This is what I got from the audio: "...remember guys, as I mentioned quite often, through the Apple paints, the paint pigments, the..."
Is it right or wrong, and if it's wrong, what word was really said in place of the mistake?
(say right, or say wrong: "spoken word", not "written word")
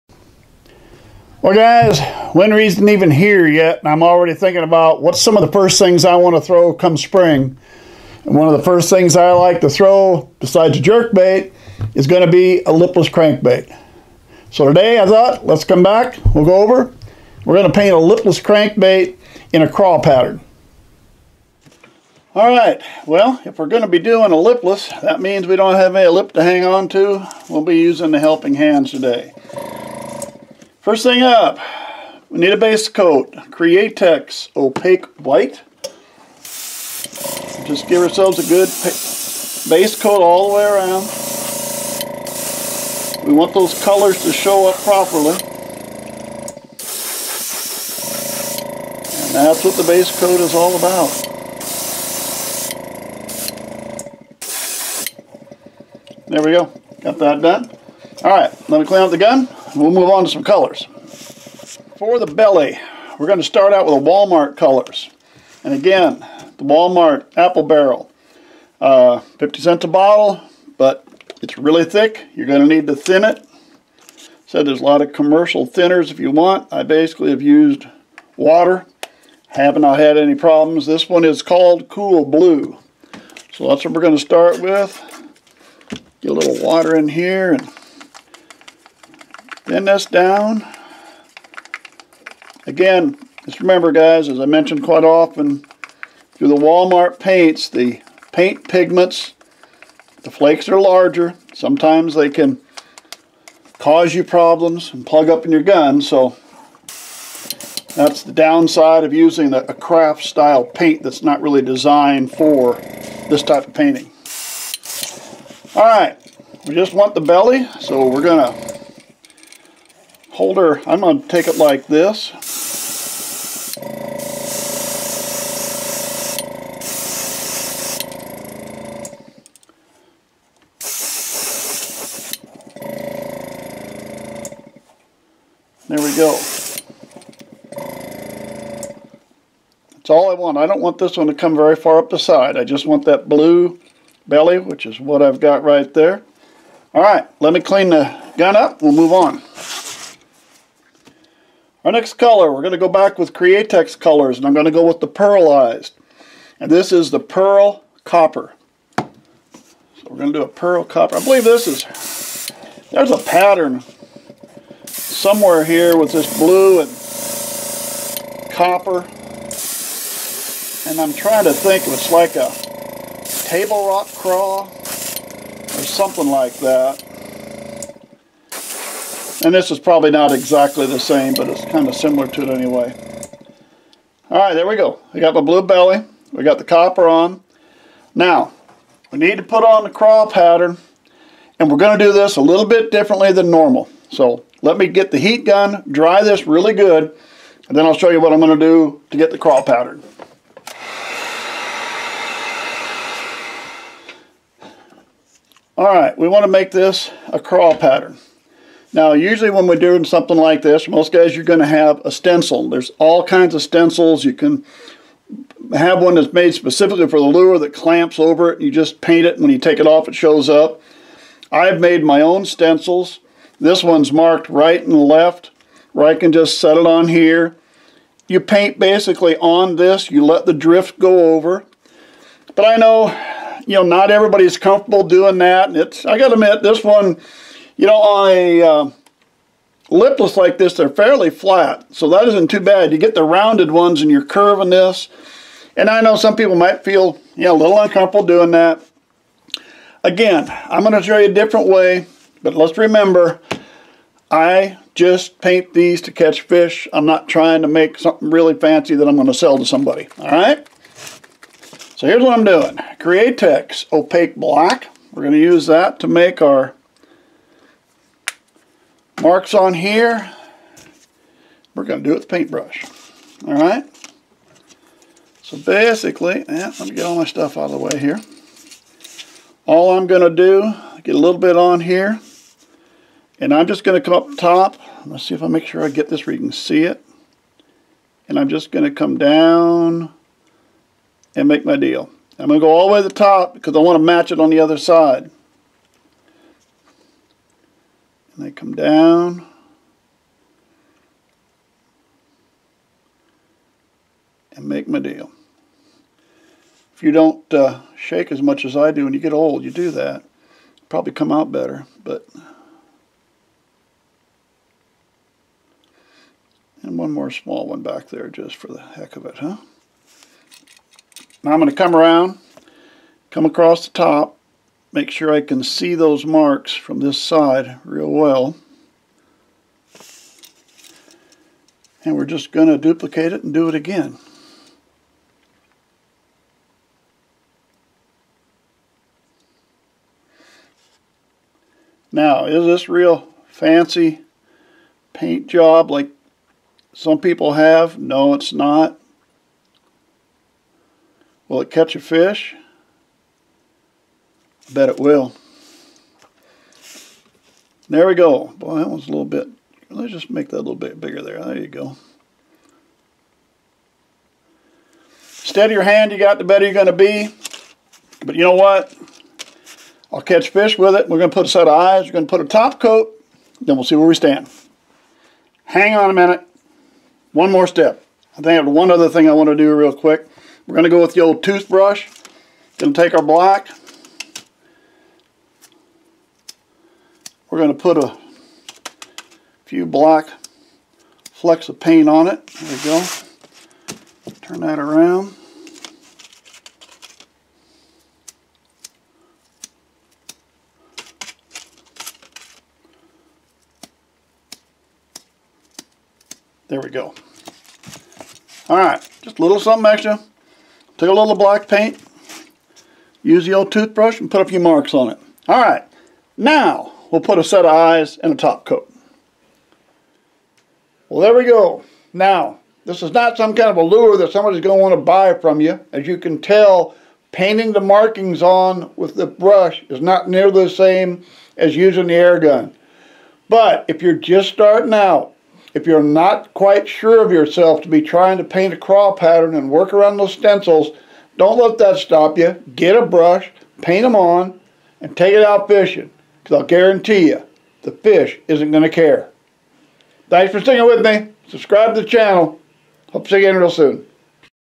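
wrong: "Walmart", not "Apple".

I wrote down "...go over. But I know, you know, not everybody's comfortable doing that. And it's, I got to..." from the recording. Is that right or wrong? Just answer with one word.
right.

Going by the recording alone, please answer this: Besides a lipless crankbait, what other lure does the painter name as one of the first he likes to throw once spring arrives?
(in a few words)
Jerk bait.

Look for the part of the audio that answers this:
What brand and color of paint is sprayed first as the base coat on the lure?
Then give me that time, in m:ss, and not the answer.
0:33.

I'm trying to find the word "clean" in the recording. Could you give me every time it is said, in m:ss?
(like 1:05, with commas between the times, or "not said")
0:58, 2:27.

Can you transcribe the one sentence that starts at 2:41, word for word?
I believe this is, there's a pattern somewhere here with this blue and copper.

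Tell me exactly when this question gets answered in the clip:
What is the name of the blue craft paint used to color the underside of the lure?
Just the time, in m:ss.
1:21.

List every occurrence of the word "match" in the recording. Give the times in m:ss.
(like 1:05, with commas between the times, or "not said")
4:54.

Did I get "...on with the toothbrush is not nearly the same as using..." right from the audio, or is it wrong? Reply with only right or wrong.
wrong.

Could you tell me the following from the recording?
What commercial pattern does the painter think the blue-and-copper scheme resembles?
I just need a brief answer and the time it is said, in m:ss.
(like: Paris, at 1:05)
Table Rock craw, at 2:53.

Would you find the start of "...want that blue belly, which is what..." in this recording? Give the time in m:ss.
2:22.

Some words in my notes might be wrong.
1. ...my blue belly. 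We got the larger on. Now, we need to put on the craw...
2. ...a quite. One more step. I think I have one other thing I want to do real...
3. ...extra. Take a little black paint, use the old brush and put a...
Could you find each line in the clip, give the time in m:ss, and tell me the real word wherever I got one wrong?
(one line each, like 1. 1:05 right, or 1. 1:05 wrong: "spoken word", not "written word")
1. 3:05 wrong: "copper", not "larger"
2. 6:16 wrong: "minute", not "quite"
3. 6:49 wrong: "toothbrush", not "brush".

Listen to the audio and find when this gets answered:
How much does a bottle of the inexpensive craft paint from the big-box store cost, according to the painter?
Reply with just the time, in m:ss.
1:09.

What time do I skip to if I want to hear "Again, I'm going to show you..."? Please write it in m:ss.
4:10.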